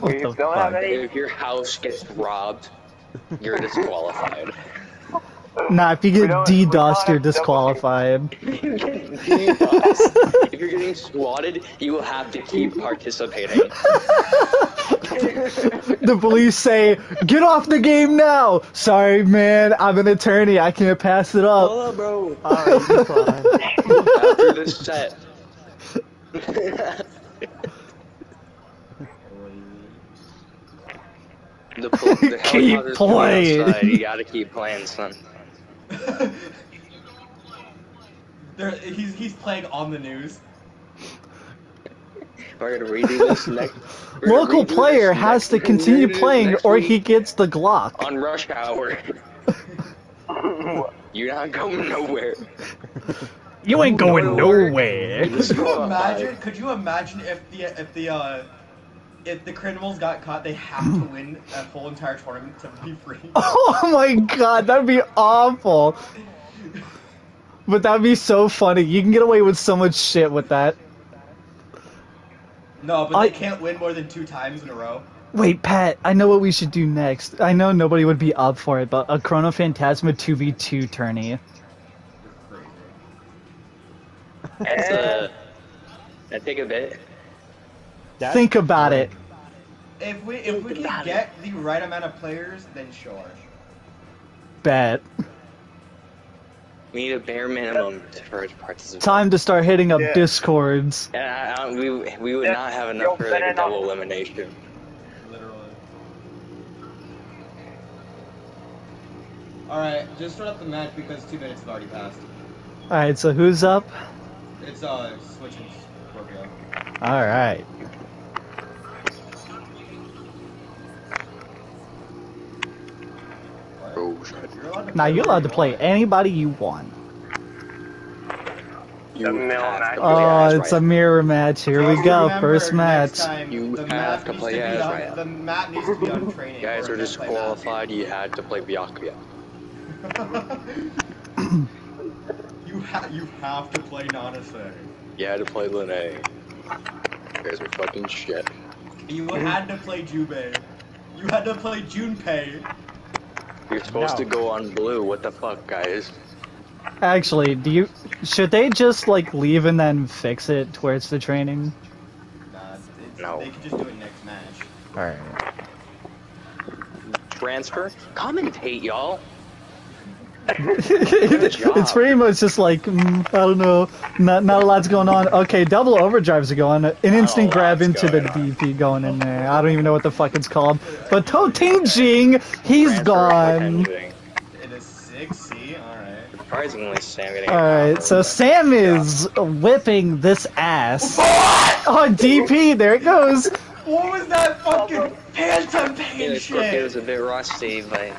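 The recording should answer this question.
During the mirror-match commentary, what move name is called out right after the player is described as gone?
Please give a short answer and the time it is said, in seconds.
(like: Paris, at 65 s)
6C, at 184 s.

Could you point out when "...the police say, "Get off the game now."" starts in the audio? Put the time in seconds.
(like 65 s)
14 s.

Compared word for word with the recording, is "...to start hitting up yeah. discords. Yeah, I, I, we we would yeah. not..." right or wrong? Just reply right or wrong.
right.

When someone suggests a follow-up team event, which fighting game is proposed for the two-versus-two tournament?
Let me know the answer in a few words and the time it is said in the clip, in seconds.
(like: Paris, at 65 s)
Chrono Phantasma, at 79 s.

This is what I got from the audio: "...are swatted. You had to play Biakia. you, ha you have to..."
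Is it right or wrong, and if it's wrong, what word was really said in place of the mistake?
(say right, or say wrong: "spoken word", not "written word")
wrong: "disqualified", not "swatted".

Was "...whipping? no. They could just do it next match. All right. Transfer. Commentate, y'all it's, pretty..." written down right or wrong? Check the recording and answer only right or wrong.
wrong.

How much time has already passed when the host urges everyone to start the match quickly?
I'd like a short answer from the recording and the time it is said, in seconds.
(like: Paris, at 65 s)
2 minutes, at 111 s.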